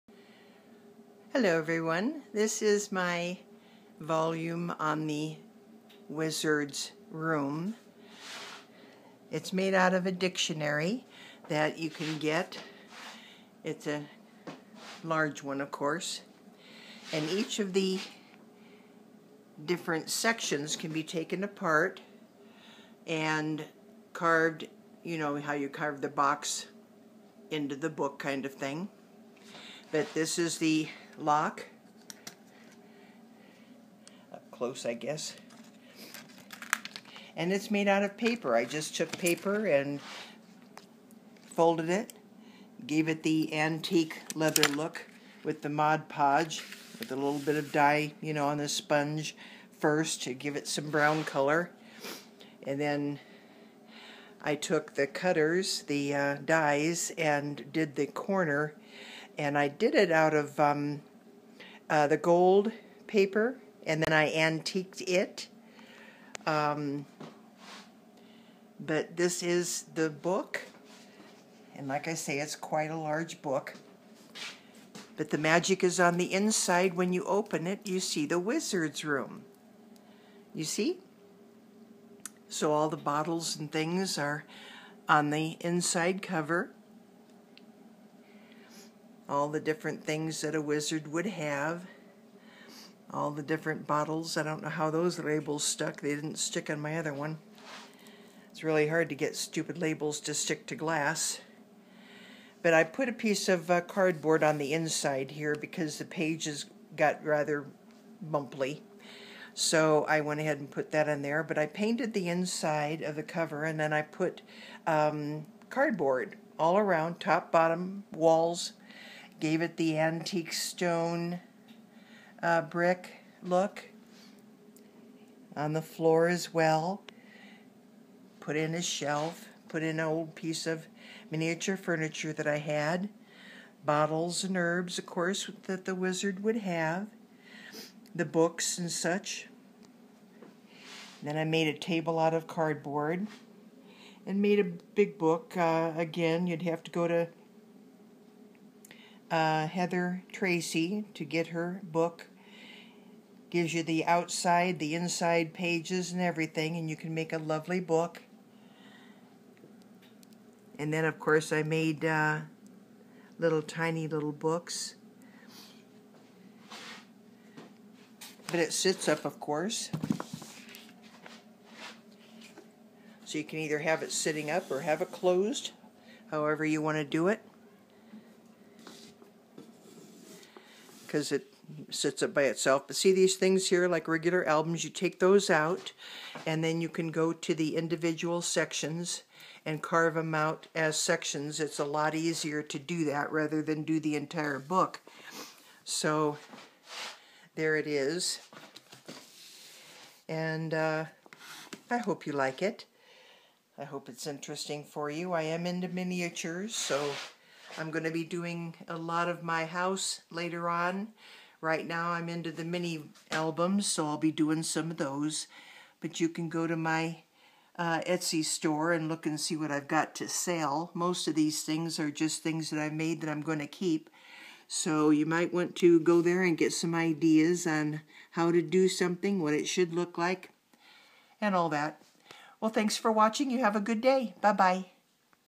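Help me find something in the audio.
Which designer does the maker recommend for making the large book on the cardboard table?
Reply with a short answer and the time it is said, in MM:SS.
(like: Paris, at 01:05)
Heather Tracy, at 02:29.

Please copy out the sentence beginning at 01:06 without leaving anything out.
Um, but this is the book, and like I say, it's quite a large book.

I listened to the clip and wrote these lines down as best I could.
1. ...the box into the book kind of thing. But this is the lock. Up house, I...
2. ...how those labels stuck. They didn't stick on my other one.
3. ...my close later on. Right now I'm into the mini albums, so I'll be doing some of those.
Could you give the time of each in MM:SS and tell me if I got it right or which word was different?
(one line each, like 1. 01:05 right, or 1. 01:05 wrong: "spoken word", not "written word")
1. 00:26 wrong: "close", not "house"
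2. 01:34 right
3. 03:29 wrong: "house", not "close".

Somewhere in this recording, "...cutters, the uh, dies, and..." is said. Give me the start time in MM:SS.
00:55.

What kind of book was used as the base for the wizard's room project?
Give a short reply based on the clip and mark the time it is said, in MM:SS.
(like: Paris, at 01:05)
Dictionary, at 00:10.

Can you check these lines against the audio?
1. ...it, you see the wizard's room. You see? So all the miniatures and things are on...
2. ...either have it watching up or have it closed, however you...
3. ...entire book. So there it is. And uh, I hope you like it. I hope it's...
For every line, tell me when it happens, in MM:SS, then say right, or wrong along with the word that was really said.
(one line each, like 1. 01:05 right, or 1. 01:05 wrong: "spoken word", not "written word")
1. 01:17 wrong: "bottles", not "miniatures"
2. 02:53 wrong: "sitting", not "watching"
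3. 03:14 right.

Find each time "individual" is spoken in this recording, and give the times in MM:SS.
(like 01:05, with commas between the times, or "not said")
03:07.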